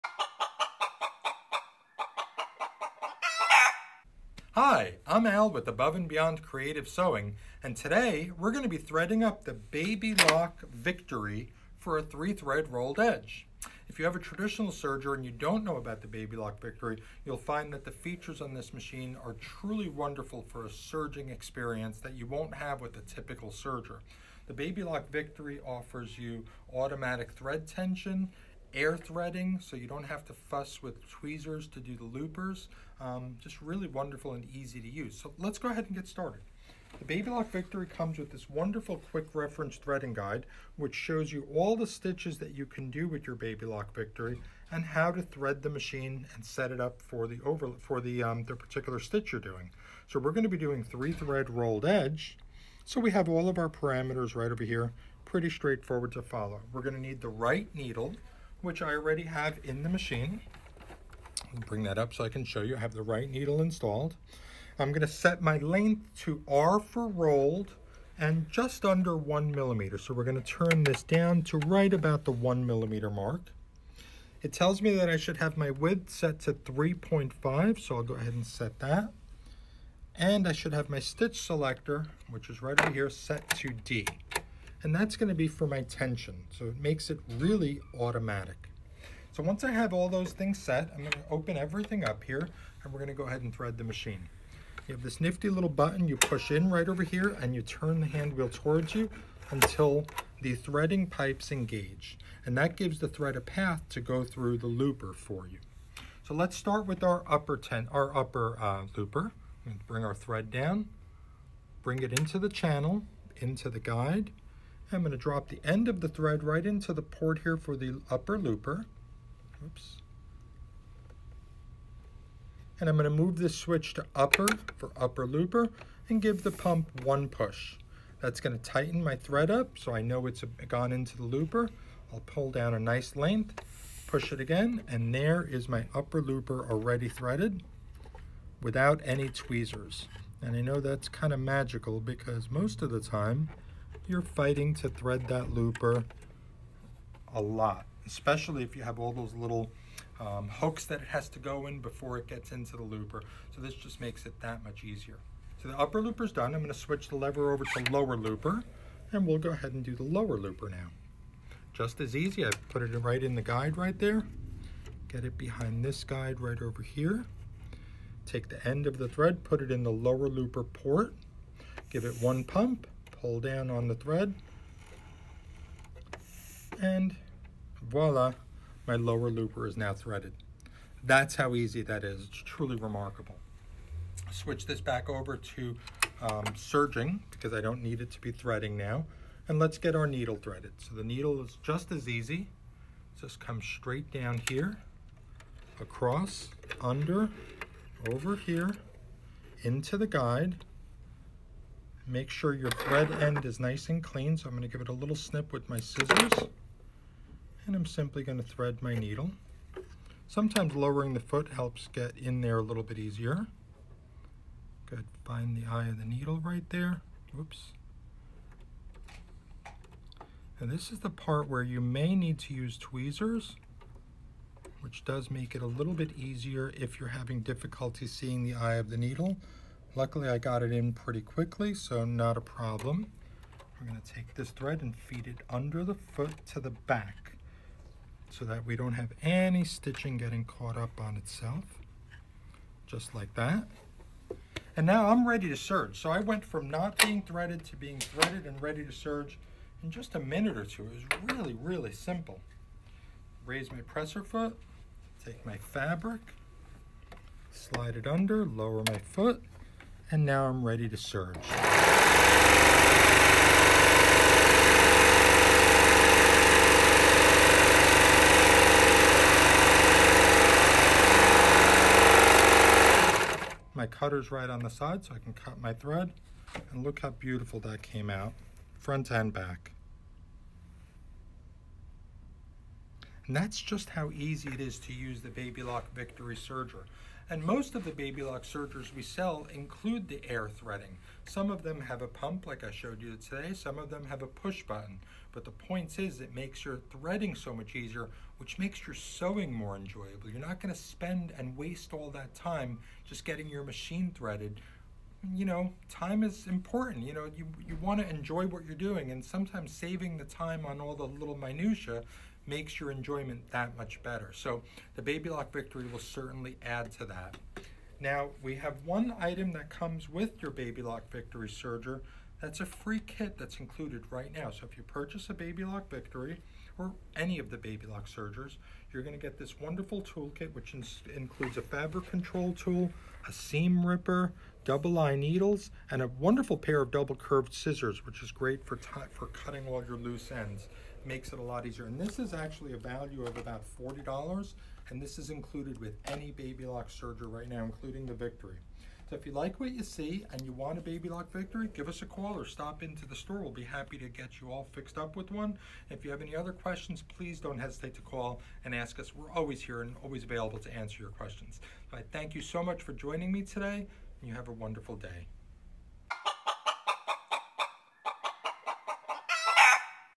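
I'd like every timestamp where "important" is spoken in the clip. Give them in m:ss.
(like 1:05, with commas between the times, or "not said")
5:06.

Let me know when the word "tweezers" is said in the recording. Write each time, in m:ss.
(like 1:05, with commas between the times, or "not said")
0:31, 2:19, 3:42.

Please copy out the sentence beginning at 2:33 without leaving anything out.
So this just makes it that much easier.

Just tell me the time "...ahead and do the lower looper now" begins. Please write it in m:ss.
2:39.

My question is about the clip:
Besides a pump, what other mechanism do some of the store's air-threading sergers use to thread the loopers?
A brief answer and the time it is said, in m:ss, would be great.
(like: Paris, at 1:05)
push button, at 4:54.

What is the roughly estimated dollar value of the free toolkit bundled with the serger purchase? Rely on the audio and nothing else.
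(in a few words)
$40.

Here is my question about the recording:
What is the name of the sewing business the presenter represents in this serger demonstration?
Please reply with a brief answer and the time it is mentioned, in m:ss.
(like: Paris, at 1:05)
Above and Beyond Creative Sewing, at 0:05.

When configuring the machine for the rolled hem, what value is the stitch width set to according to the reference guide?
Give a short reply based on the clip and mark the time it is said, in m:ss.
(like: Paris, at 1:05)
3.5, at 1:16.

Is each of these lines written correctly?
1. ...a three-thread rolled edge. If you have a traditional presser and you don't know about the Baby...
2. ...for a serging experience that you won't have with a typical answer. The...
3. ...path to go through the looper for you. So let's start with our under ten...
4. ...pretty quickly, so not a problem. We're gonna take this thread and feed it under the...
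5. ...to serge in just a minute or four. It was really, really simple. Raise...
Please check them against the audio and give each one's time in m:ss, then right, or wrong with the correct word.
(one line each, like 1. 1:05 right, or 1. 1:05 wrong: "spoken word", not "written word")
1. 0:11 wrong: "serger", not "presser"
2. 0:20 wrong: "serger", not "answer"
3. 1:43 wrong: "upper", not "under"
4. 3:50 right
5. 4:08 wrong: "two", not "four".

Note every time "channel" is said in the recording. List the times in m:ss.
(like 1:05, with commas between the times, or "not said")
1:52.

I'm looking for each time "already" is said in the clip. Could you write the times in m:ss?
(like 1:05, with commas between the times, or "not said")
0:58, 2:16.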